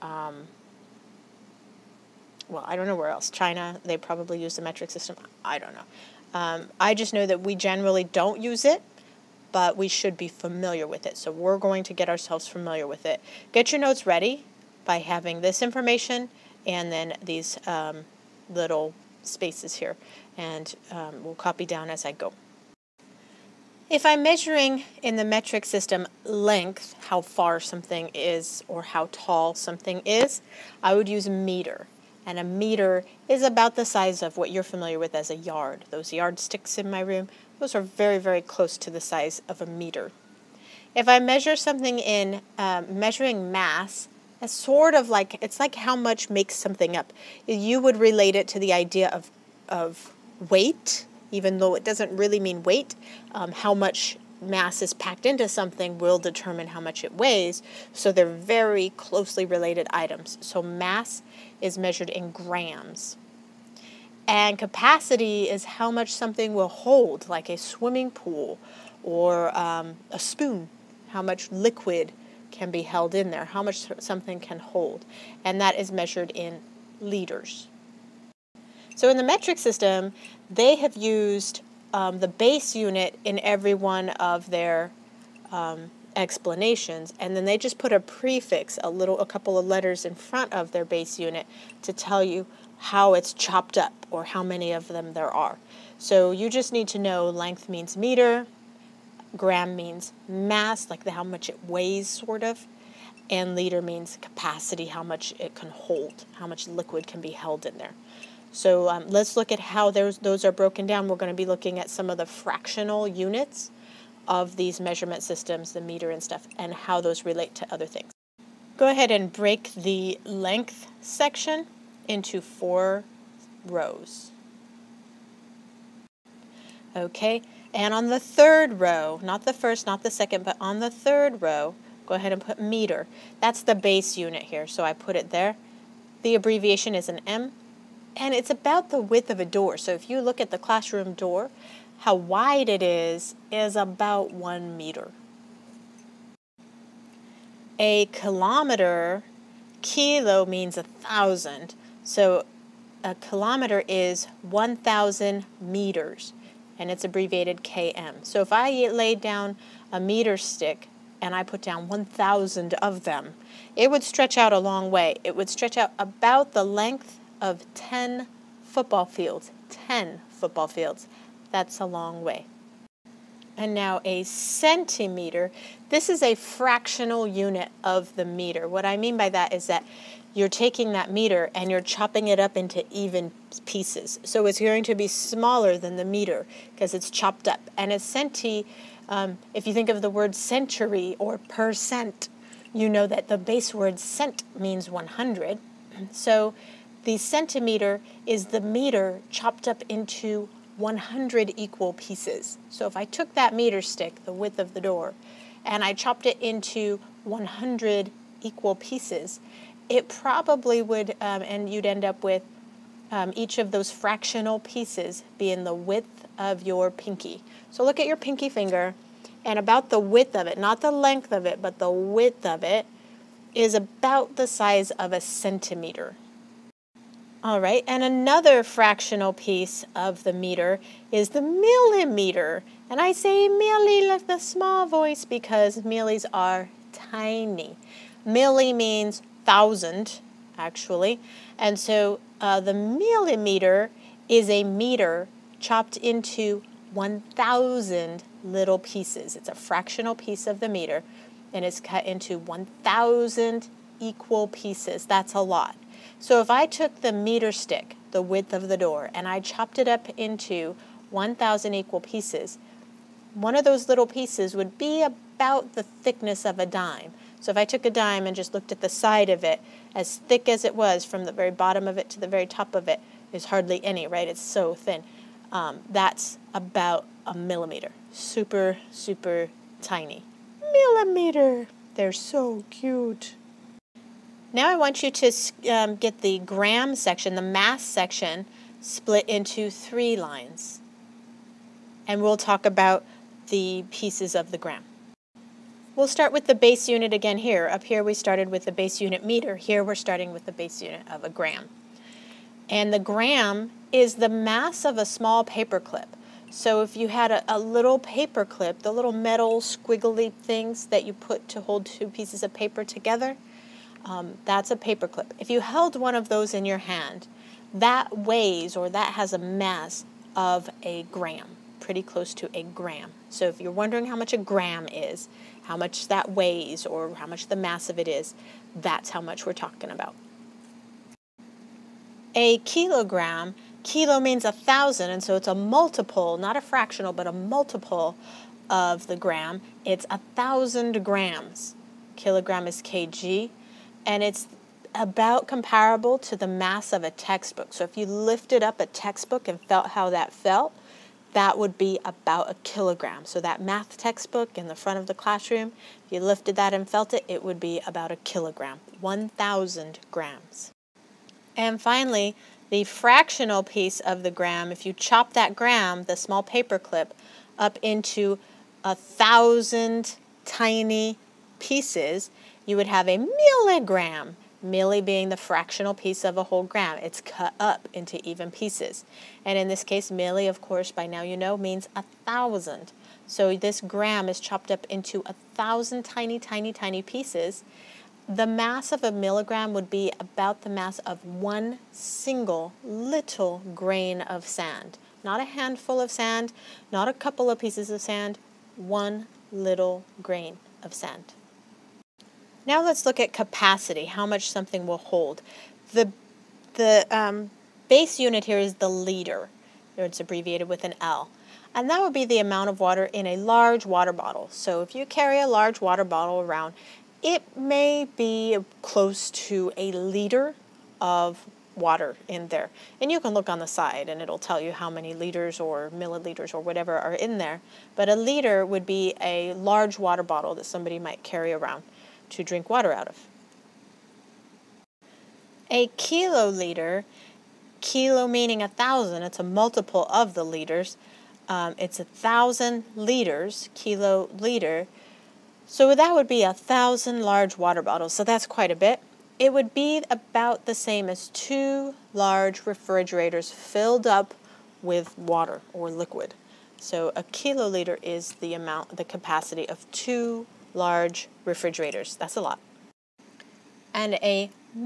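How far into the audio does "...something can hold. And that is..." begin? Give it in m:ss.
1:13.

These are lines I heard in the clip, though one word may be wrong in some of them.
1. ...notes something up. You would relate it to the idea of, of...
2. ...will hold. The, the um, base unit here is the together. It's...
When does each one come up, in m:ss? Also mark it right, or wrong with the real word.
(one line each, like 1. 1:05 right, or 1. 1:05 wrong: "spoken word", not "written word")
1. 0:46 wrong: "makes", not "notes"
2. 6:44 wrong: "liter", not "together".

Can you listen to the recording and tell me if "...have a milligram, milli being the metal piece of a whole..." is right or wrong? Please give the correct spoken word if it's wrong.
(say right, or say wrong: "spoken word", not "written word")
wrong: "fractional", not "metal".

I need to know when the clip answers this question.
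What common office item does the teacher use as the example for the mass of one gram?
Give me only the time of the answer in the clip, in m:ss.
5:05.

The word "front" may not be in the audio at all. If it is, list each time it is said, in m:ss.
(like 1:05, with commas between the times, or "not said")
1:30, 5:54.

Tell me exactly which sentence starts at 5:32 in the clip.
A kilogram, kilo means a thousand, and so it's a multiple, not a fractional, but a multiple of the gram.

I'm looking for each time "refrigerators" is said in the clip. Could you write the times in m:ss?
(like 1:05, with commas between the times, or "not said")
7:32, 7:41.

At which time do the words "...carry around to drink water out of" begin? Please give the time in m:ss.
7:11.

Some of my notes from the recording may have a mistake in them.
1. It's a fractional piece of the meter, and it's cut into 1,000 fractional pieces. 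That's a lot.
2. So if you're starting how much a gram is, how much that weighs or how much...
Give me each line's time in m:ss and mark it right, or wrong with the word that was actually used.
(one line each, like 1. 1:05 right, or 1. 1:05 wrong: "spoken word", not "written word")
1. 4:09 wrong: "equal", not "fractional"
2. 5:23 wrong: "wondering", not "starting".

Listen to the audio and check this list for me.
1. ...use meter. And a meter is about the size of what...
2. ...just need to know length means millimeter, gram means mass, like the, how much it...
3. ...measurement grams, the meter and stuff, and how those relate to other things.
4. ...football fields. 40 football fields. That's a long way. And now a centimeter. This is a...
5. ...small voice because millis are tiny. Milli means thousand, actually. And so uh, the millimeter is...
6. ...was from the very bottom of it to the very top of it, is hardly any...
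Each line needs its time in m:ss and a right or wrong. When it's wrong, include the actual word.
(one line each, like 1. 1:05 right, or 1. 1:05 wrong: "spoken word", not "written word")
1. 0:31 right
2. 1:36 wrong: "meter", not "millimeter"
3. 1:54 wrong: "systems", not "grams"
4. 2:48 wrong: "10", not "40"
5. 3:54 right
6. 4:30 right.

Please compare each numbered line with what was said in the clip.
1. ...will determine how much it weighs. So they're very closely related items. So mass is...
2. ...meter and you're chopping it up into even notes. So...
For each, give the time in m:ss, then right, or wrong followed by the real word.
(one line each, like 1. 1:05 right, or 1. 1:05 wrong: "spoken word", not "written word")
1. 0:55 right
2. 3:01 wrong: "pieces", not "notes".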